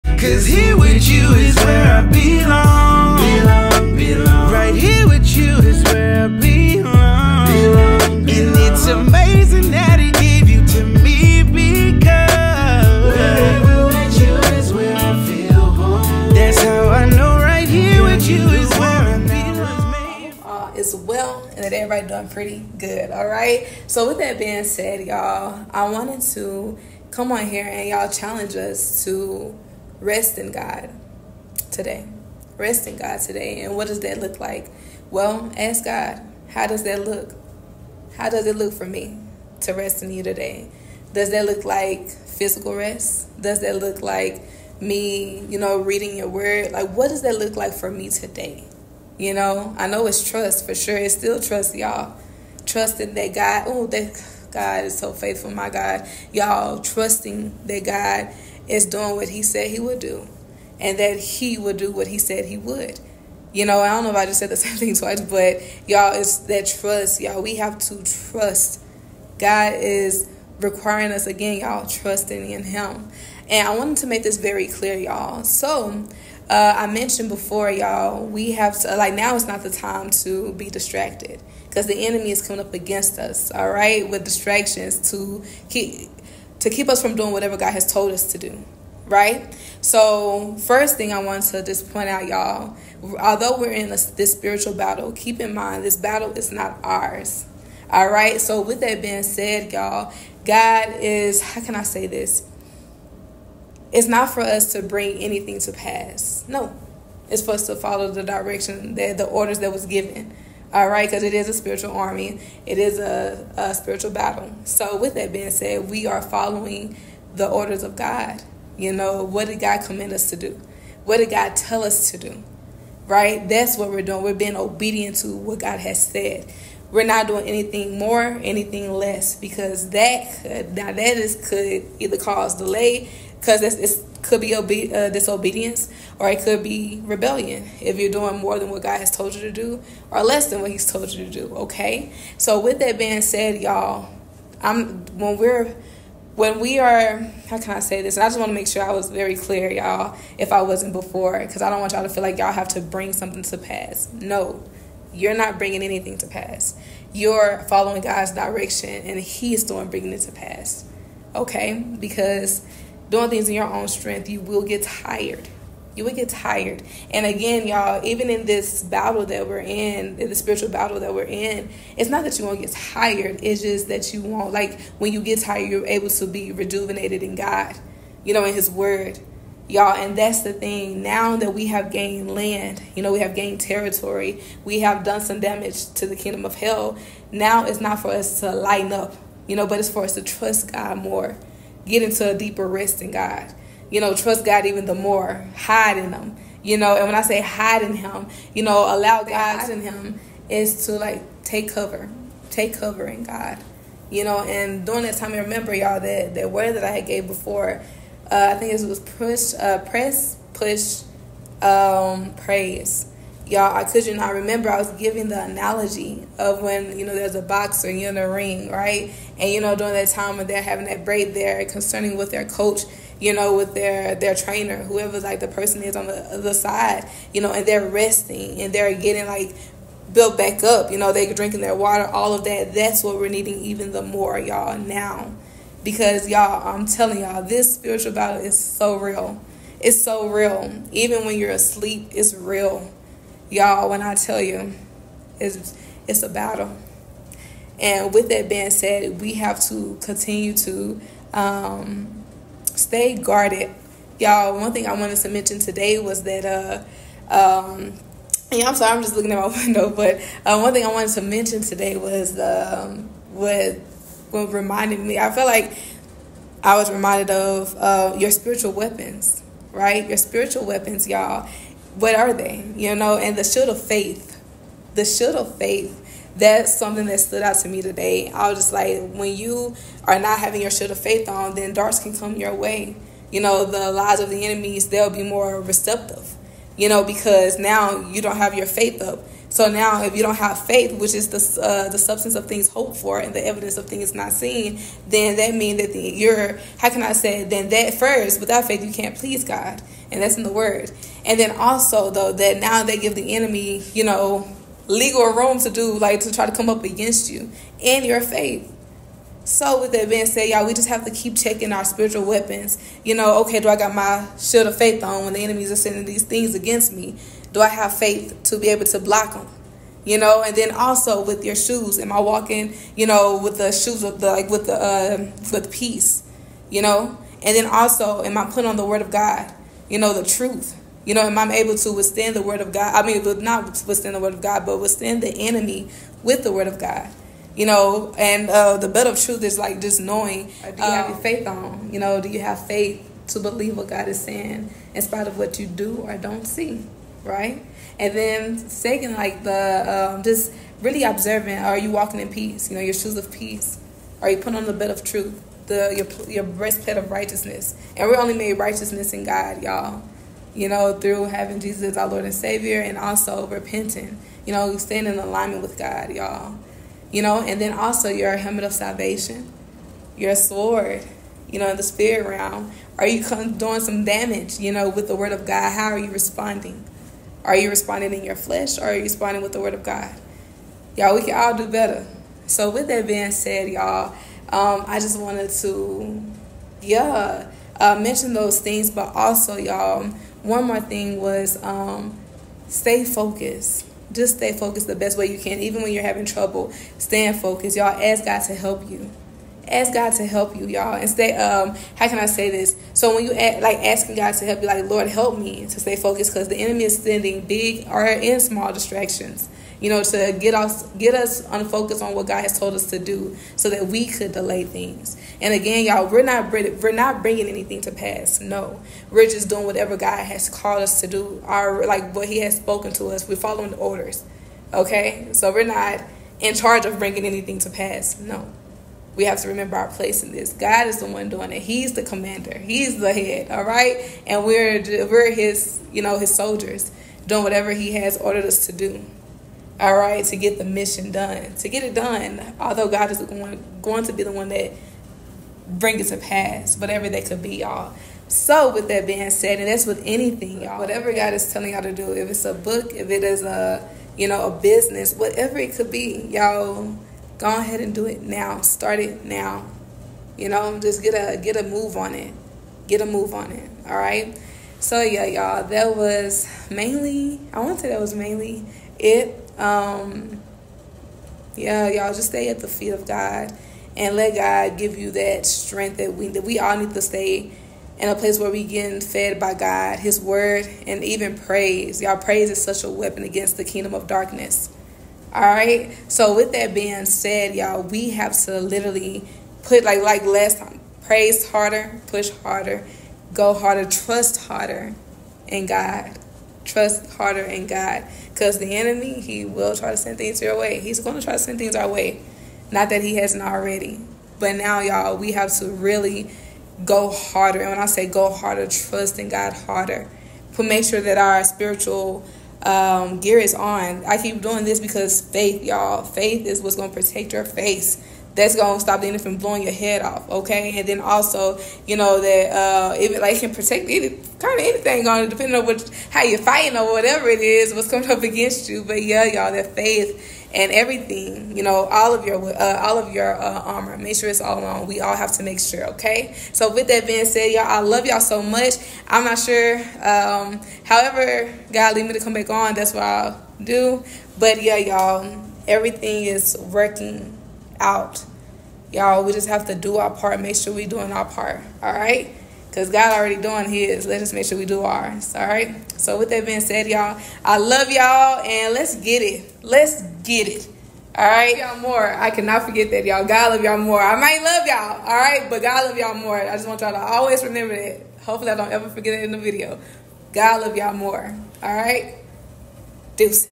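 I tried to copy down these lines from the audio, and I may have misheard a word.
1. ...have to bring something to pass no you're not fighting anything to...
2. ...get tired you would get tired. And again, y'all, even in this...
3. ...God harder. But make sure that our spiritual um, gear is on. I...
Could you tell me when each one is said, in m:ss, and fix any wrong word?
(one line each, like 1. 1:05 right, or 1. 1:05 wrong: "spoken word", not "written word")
1. 2:32 wrong: "bringing", not "fighting"
2. 2:44 right
3. 8:29 right.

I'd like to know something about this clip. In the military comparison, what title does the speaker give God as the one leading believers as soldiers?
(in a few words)
The commander.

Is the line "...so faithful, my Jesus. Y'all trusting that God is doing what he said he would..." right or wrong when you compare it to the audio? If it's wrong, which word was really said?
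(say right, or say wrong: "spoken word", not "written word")
wrong: "God", not "Jesus".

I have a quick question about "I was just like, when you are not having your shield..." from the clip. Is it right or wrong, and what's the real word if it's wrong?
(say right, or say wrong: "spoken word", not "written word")
right.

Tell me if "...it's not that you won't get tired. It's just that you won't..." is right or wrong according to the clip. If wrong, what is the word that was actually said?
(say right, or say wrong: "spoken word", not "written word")
right.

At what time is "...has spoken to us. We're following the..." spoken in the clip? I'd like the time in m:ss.
7:02.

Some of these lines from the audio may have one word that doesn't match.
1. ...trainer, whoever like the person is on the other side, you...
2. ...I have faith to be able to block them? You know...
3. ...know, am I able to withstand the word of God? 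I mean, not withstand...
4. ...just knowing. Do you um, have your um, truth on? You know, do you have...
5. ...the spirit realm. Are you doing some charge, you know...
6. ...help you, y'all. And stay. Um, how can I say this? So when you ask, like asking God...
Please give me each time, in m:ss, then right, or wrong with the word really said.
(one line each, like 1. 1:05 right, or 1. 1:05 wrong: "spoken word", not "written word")
1. 3:44 right
2. 5:17 right
3. 5:31 right
4. 5:39 wrong: "faith", not "truth"
5. 6:11 wrong: "damage", not "charge"
6. 6:40 right.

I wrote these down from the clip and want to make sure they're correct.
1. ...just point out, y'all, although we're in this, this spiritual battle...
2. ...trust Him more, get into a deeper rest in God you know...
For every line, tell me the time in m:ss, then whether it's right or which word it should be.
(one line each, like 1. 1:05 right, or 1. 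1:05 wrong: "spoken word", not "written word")
1. 1:31 right
2. 3:10 wrong: "God", not "Him".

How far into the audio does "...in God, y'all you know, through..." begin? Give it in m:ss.
5:59.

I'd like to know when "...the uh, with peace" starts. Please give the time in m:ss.
5:24.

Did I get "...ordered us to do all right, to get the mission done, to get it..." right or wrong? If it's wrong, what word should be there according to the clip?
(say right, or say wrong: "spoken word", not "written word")
right.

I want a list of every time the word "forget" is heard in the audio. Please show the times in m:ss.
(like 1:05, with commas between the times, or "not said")
9:22, 9:28.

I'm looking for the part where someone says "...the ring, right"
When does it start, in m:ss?
3:38.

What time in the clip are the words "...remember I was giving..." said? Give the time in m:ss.
3:34.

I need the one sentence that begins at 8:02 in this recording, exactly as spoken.
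Y'all, praise is such a weapon against the kingdom of darkness.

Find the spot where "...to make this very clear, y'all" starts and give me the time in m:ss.
1:13.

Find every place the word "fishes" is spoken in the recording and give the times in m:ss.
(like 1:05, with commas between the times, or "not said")
not said.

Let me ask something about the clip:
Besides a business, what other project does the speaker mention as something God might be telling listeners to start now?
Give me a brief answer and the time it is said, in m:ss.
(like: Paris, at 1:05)
A book, at 7:32.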